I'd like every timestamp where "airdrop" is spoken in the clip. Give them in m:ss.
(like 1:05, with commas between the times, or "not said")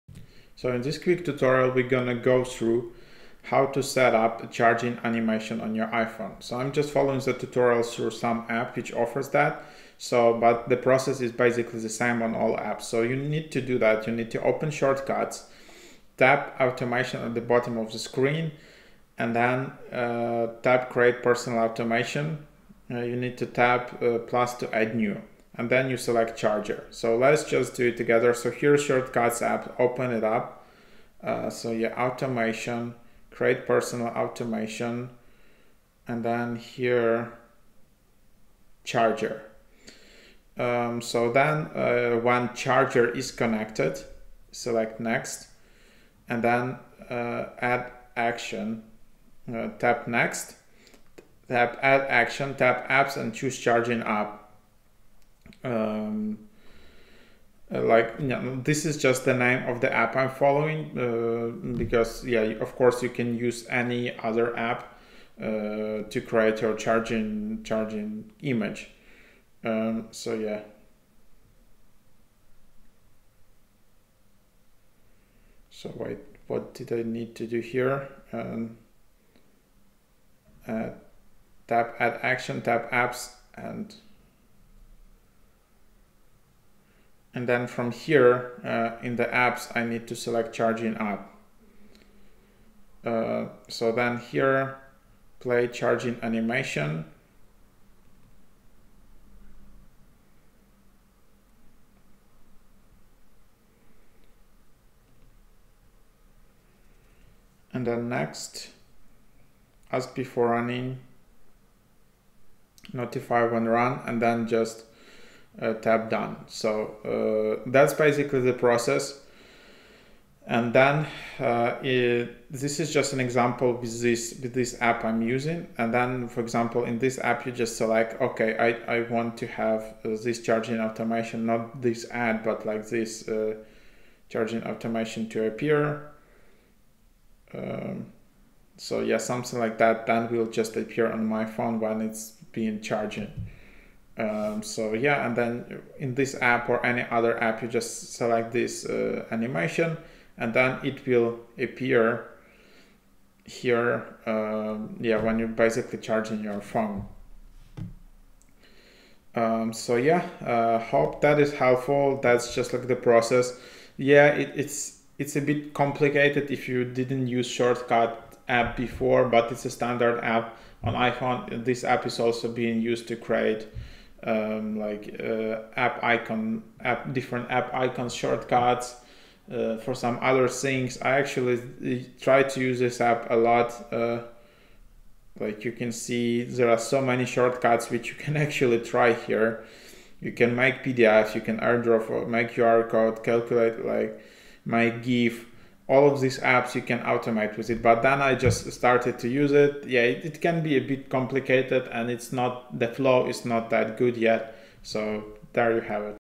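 3:11.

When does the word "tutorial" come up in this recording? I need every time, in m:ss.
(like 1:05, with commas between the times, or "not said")
0:01, 0:07.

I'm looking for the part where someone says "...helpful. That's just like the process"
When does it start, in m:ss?
2:41.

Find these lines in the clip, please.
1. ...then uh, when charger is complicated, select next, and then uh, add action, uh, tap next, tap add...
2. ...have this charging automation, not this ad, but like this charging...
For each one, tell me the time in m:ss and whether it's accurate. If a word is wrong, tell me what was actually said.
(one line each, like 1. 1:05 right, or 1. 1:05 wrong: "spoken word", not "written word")
1. 0:41 wrong: "connected", not "complicated"
2. 2:09 right.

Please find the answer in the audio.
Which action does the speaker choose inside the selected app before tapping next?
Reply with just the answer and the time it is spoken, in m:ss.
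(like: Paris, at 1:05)
Play charging animation, at 1:35.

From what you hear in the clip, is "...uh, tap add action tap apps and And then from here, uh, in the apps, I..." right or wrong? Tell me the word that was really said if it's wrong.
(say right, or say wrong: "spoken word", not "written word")
right.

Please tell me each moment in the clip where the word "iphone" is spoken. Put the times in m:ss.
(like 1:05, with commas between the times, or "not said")
0:05, 2:50.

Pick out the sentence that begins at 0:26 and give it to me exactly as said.
So let's just do it together.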